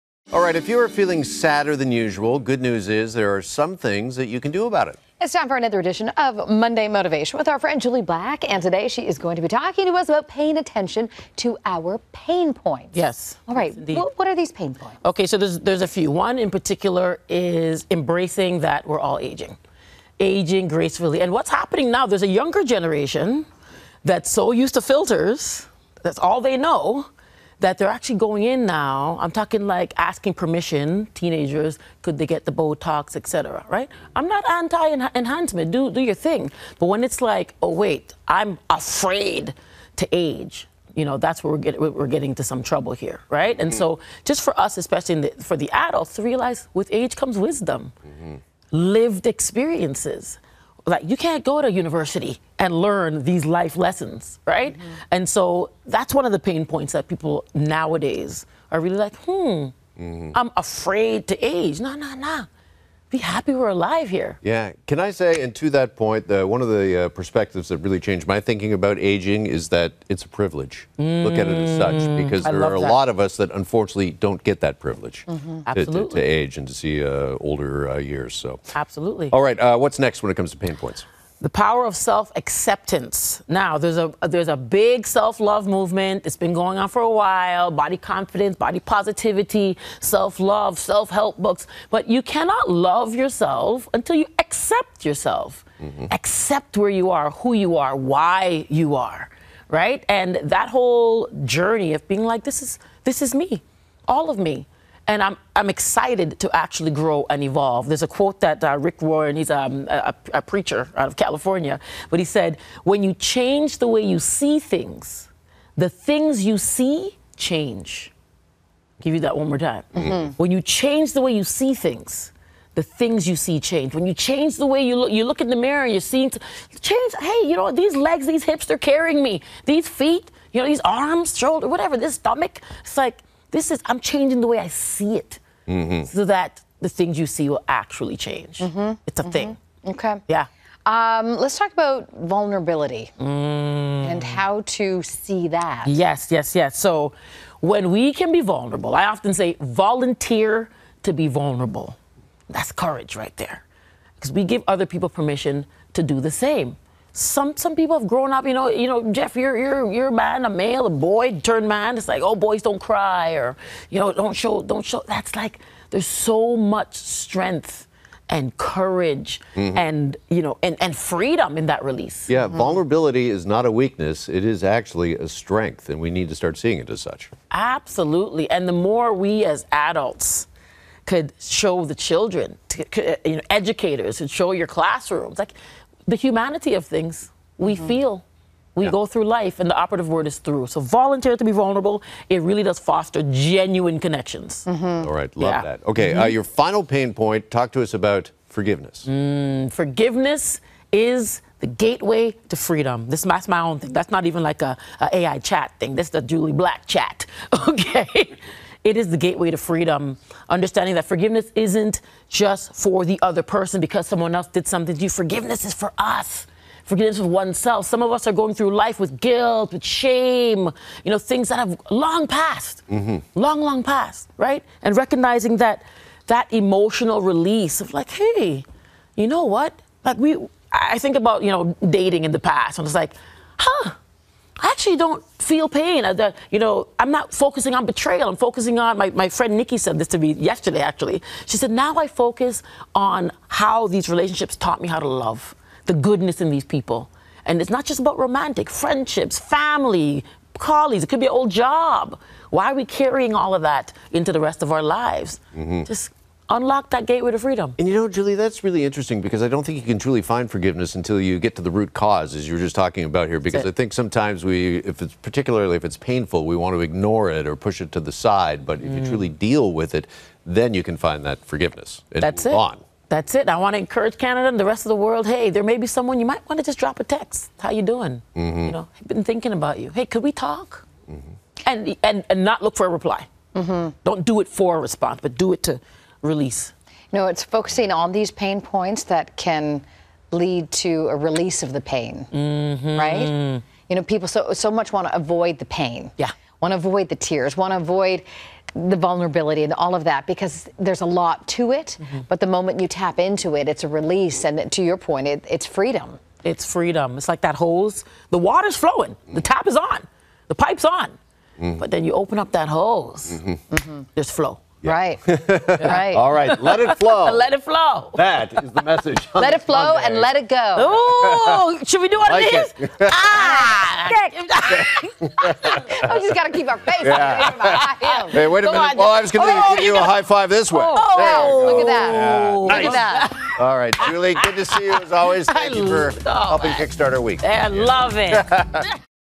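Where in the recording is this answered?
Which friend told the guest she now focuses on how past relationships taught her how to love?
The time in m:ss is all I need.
3:59.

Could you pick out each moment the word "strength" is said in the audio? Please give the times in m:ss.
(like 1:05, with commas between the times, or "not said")
2:46, 2:55.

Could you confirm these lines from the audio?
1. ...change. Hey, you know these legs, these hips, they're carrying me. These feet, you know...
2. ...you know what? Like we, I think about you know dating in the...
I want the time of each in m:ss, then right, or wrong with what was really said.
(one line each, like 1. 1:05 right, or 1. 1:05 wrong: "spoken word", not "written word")
1. 2:06 right
2. 3:49 right.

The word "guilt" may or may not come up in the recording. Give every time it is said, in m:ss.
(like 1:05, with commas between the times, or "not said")
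3:39.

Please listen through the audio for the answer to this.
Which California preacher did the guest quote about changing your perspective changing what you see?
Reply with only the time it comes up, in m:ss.
1:48.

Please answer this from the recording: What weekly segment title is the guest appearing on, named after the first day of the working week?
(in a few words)
Monday Motivation.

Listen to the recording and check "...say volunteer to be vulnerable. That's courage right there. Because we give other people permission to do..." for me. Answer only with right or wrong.
right.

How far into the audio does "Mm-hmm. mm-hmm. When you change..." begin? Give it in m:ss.
1:59.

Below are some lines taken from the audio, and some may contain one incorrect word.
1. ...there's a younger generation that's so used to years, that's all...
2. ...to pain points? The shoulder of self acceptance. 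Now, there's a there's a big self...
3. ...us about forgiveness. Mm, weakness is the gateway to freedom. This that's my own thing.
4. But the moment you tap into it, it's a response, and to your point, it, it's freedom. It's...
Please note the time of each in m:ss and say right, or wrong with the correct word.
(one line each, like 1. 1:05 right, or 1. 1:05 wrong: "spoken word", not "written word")
1. 0:22 wrong: "filters", not "years"
2. 1:20 wrong: "power", not "shoulder"
3. 3:17 wrong: "forgiveness", not "weakness"
4. 5:02 wrong: "release", not "response".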